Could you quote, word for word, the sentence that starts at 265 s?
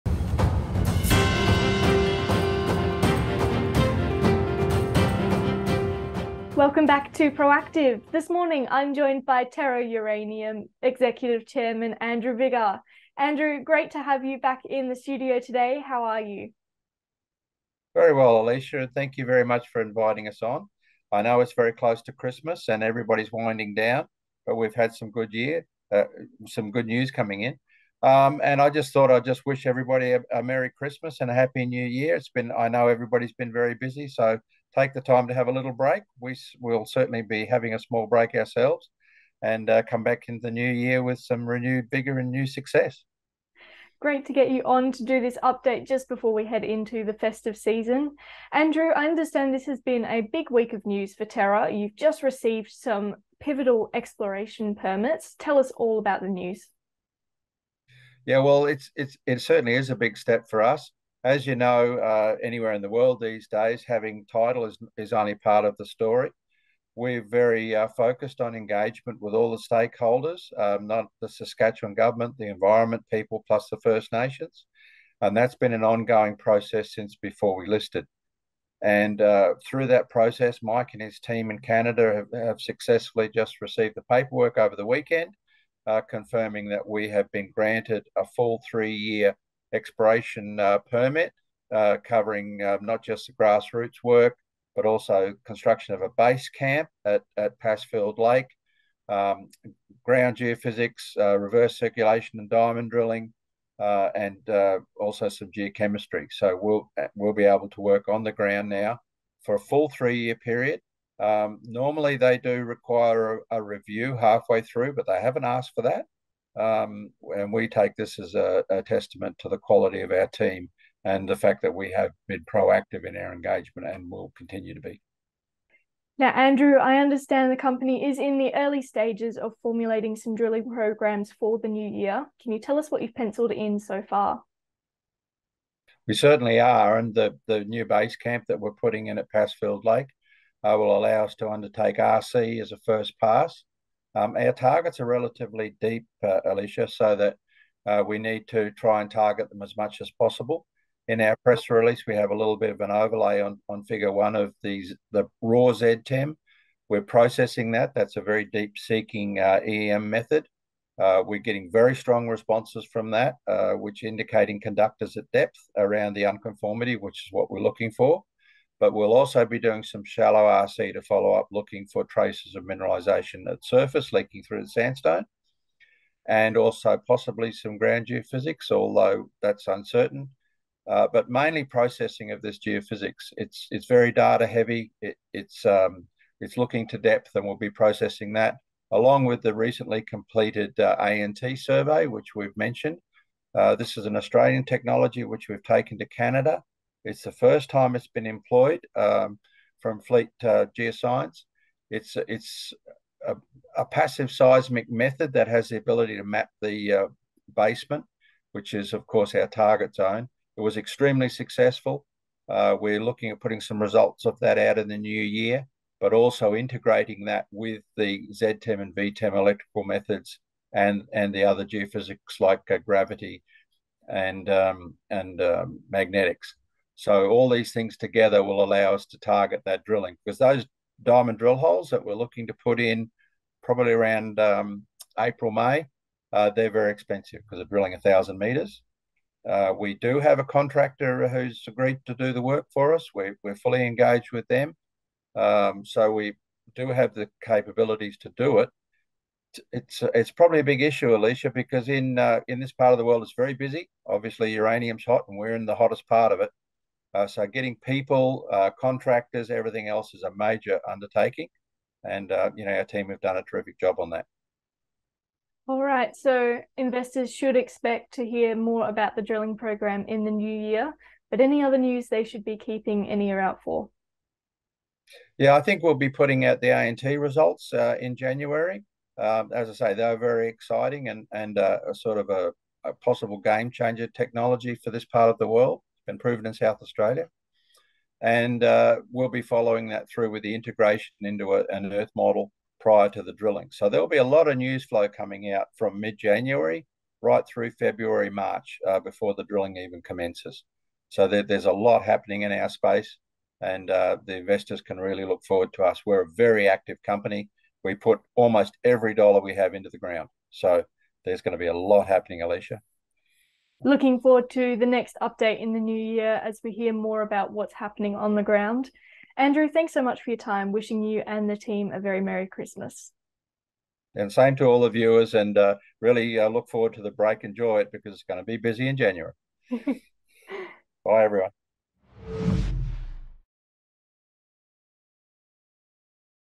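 All right, so investors should expect to hear more about the drilling program in the new year.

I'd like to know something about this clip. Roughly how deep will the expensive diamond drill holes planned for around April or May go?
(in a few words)
1,000 meters.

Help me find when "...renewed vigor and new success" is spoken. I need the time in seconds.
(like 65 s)
41 s.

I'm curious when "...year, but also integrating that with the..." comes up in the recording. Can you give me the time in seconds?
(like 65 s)
215 s.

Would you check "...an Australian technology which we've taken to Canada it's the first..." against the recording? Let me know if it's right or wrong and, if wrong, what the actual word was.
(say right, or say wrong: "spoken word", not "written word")
right.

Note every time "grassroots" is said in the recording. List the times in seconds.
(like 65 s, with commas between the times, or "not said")
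93 s.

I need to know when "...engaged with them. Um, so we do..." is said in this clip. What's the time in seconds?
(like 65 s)
243 s.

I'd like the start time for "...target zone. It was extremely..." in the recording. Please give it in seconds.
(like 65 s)
209 s.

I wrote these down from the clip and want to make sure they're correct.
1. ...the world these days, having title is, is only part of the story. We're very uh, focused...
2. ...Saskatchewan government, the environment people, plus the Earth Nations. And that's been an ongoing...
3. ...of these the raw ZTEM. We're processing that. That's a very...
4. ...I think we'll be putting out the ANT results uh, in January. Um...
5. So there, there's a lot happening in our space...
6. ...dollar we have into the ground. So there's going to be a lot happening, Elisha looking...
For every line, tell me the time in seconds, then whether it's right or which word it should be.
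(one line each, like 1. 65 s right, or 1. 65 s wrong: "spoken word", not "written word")
1. 62 s right
2. 71 s wrong: "First", not "Earth"
3. 154 s right
4. 275 s right
5. 301 s right
6. 309 s right.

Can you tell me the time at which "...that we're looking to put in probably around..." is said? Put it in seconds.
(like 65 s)
231 s.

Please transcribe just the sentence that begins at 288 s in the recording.
And uh, we'll be following that through with the integration into a, an Earth model prior to the drilling.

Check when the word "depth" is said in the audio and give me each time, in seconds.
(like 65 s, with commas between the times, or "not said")
165 s, 186 s.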